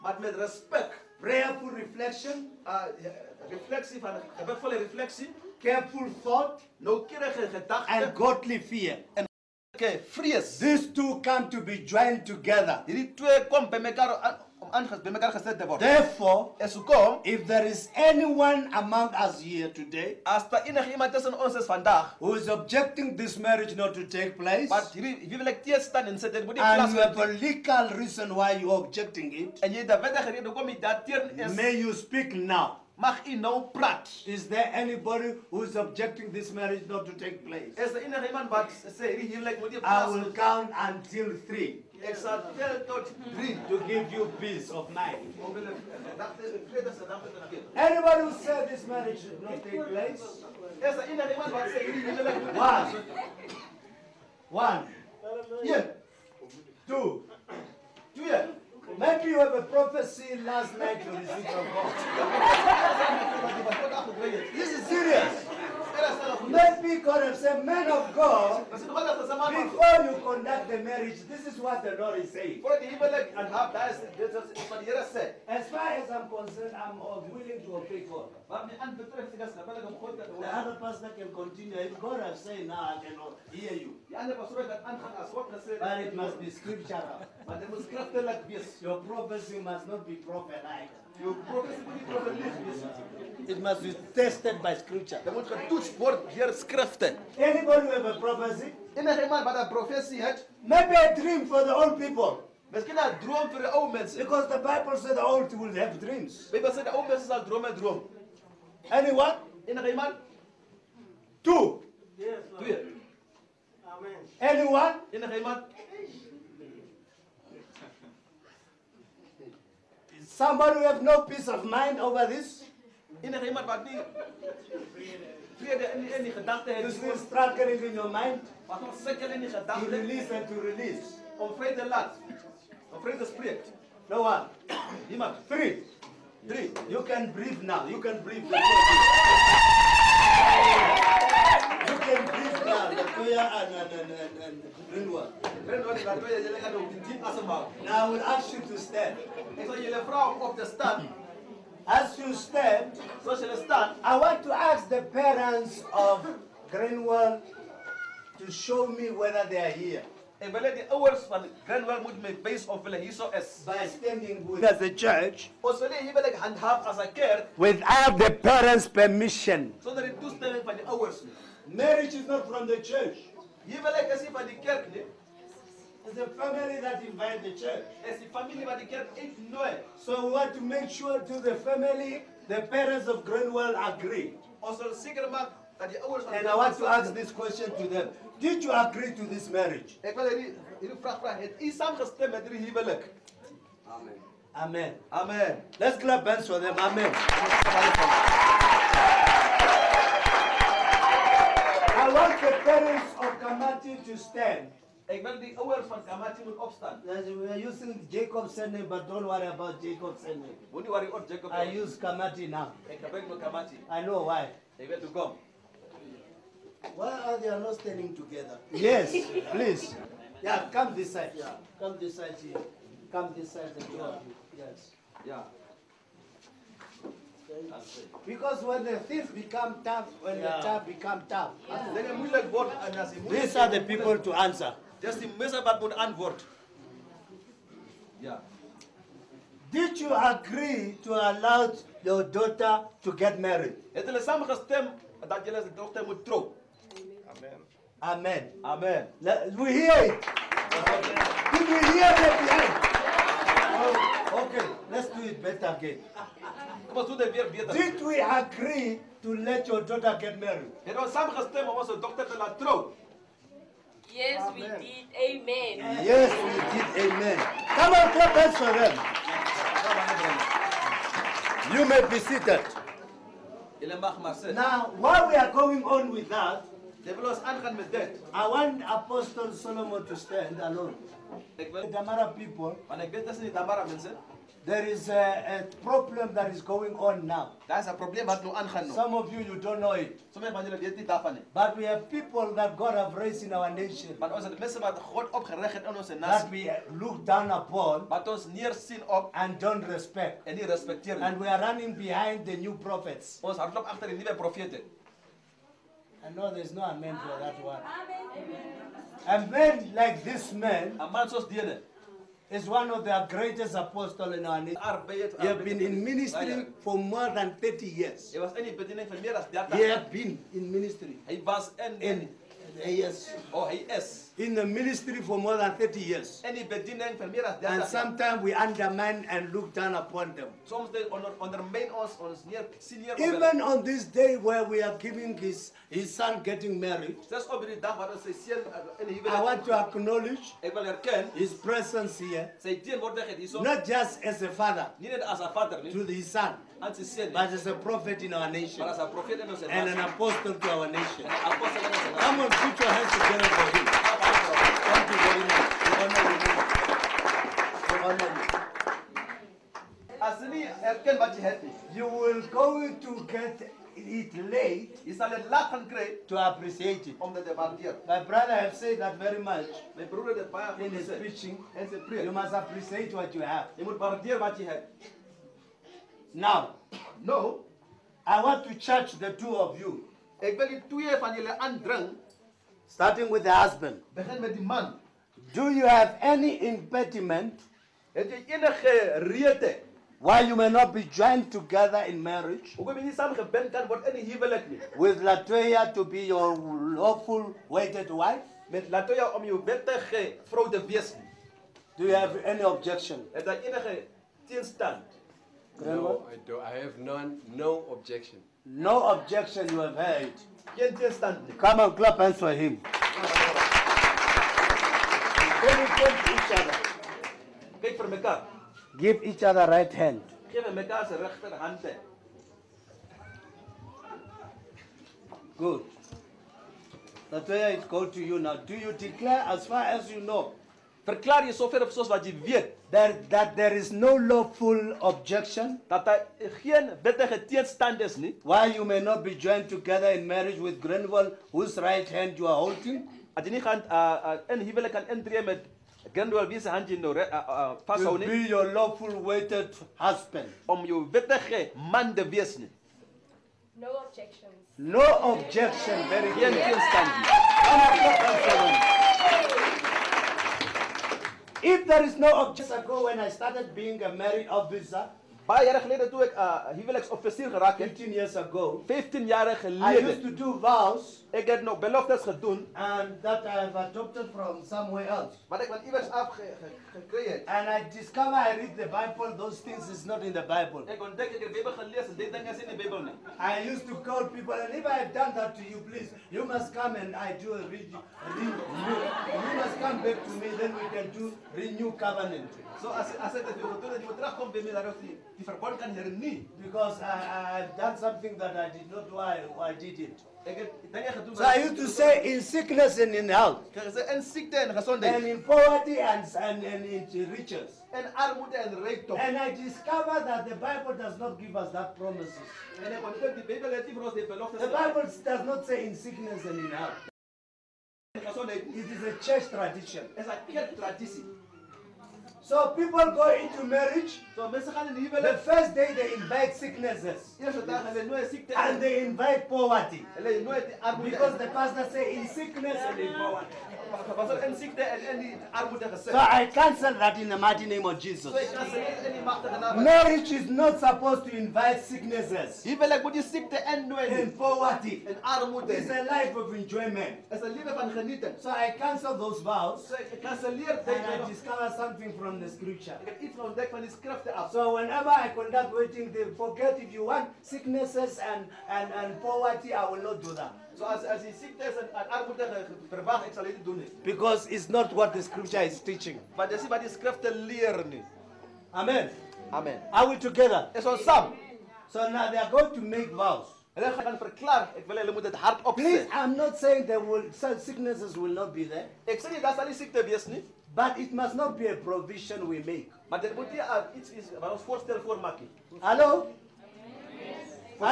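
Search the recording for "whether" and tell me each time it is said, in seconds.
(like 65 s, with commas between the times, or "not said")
159 s.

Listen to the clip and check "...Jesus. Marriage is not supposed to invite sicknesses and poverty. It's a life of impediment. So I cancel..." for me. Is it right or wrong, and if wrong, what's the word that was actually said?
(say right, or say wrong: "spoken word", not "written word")
wrong: "enjoyment", not "impediment".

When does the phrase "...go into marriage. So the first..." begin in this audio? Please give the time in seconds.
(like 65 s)
522 s.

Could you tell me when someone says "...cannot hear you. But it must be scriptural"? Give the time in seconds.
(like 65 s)
83 s.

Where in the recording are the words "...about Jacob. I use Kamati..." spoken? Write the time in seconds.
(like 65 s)
211 s.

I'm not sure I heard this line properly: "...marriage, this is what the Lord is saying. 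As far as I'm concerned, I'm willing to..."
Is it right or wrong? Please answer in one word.
right.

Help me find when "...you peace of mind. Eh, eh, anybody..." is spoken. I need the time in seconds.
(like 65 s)
44 s.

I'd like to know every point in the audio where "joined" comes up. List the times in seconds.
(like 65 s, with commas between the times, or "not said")
11 s, 391 s, 439 s.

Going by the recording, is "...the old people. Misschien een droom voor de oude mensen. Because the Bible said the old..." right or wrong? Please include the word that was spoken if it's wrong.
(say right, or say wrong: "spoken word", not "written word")
right.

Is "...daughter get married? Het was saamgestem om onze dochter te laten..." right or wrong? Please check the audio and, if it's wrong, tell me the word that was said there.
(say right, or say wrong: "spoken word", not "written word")
right.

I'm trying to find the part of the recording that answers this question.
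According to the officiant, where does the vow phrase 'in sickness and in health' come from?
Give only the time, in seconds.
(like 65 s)
519 s.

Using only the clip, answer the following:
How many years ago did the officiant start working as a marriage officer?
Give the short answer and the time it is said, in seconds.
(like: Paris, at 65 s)
15, at 467 s.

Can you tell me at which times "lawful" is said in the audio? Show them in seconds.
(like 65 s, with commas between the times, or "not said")
396 s, 434 s, 448 s.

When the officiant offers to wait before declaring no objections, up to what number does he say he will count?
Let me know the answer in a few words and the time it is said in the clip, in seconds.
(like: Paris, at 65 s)
3, at 40 s.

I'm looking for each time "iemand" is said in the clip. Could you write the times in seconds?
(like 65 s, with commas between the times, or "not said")
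38 s, 51 s, 109 s, 115 s, 123 s, 475 s.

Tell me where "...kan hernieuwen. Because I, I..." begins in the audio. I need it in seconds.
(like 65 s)
495 s.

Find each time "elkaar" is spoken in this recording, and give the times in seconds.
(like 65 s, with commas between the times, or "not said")
418 s.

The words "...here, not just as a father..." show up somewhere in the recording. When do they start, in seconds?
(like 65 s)
342 s.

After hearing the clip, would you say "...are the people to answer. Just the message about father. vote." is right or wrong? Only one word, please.
wrong.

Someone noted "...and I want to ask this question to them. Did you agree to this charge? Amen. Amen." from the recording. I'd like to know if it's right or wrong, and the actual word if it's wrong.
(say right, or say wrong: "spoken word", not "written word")
wrong: "marriage", not "charge".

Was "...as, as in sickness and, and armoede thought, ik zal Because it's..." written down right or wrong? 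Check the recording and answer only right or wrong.
wrong.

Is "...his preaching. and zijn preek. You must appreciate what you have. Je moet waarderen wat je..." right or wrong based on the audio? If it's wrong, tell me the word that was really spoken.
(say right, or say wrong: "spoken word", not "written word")
right.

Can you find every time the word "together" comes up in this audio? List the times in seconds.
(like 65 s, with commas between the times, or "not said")
12 s, 218 s, 353 s, 391 s, 439 s, 570 s.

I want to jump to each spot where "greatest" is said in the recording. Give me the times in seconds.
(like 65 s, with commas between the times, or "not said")
313 s.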